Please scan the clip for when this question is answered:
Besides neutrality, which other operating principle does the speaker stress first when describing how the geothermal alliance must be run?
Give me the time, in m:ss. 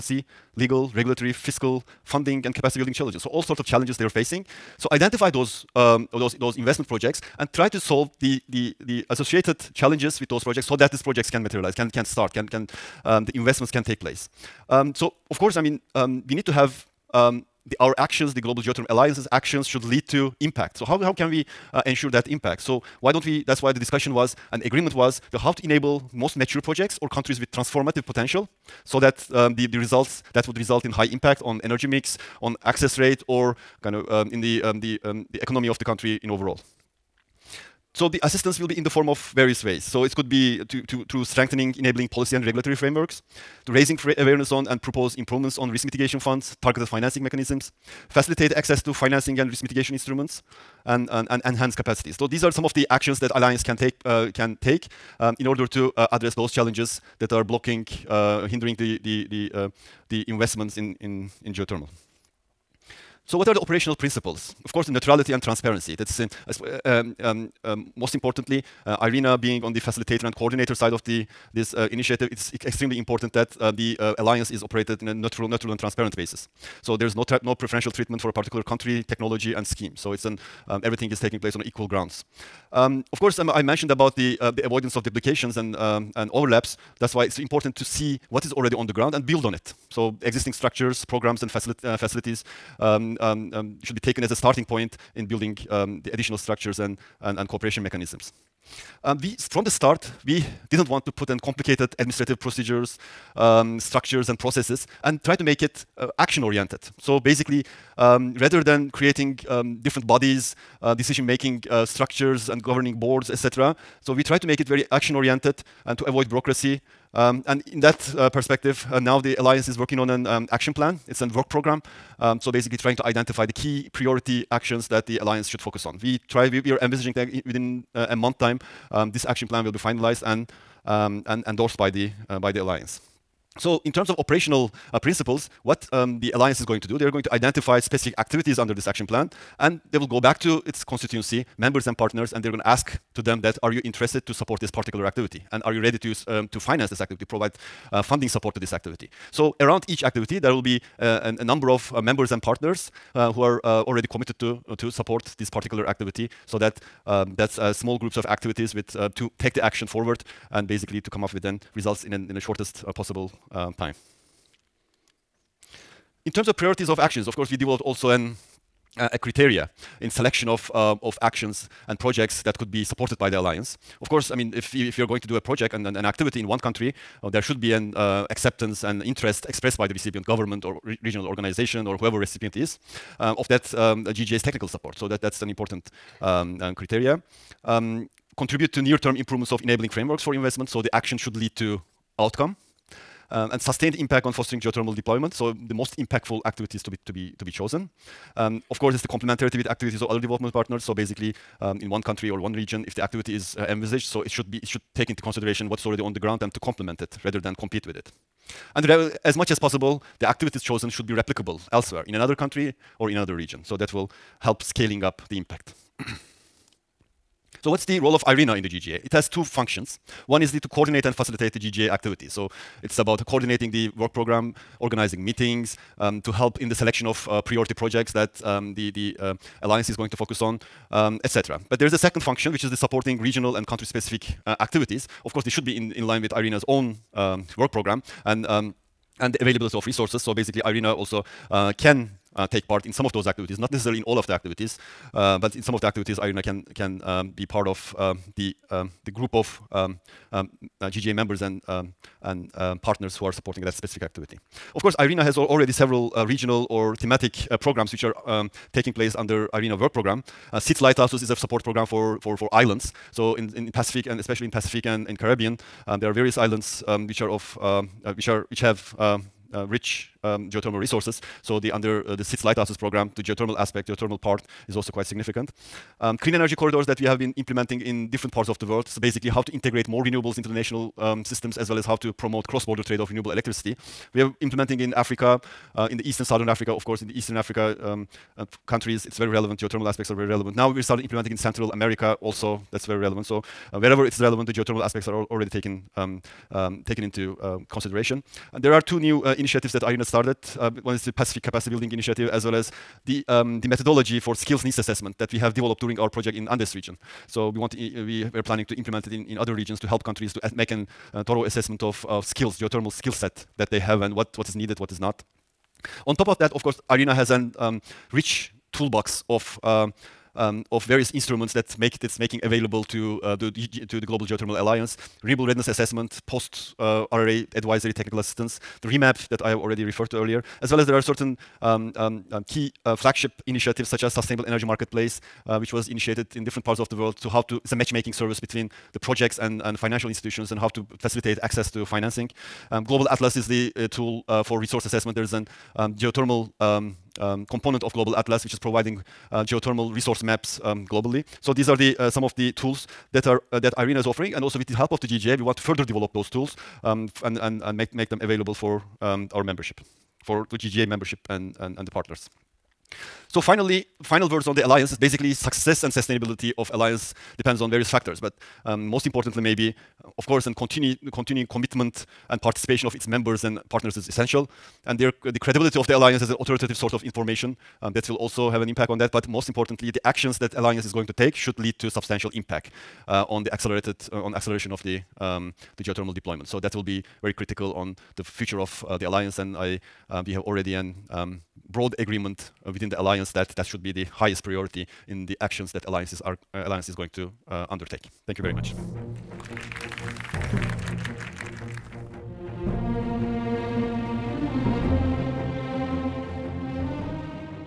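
1:05.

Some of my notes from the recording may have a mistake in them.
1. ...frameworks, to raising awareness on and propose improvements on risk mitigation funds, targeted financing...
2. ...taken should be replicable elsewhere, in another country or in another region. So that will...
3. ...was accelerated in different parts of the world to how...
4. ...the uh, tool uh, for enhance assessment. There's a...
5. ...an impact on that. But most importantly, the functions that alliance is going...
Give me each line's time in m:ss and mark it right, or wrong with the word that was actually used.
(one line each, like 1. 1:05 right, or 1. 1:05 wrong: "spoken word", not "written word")
1. 0:42 right
2. 3:30 wrong: "chosen", not "taken"
3. 5:35 wrong: "initiated", not "accelerated"
4. 5:43 wrong: "resource", not "enhance"
5. 6:18 wrong: "actions", not "functions".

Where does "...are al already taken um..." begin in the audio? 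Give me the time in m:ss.
4:55.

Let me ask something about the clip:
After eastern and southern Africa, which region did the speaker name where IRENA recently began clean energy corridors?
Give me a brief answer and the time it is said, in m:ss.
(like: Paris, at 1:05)
Central America, at 4:51.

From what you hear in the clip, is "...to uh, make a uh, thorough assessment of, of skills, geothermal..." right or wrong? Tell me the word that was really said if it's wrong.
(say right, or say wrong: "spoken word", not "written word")
right.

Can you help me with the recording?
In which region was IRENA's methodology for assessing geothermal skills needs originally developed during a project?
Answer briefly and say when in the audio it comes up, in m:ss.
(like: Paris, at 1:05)
Andes region, at 5:06.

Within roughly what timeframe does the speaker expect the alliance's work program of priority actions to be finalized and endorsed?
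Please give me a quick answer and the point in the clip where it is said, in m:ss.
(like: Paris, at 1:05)
A month, at 2:07.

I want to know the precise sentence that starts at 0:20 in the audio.
So how, how can we uh, ensure that impact?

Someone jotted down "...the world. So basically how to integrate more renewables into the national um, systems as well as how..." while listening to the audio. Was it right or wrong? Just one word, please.
right.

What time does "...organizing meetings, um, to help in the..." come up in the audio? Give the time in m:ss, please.
3:44.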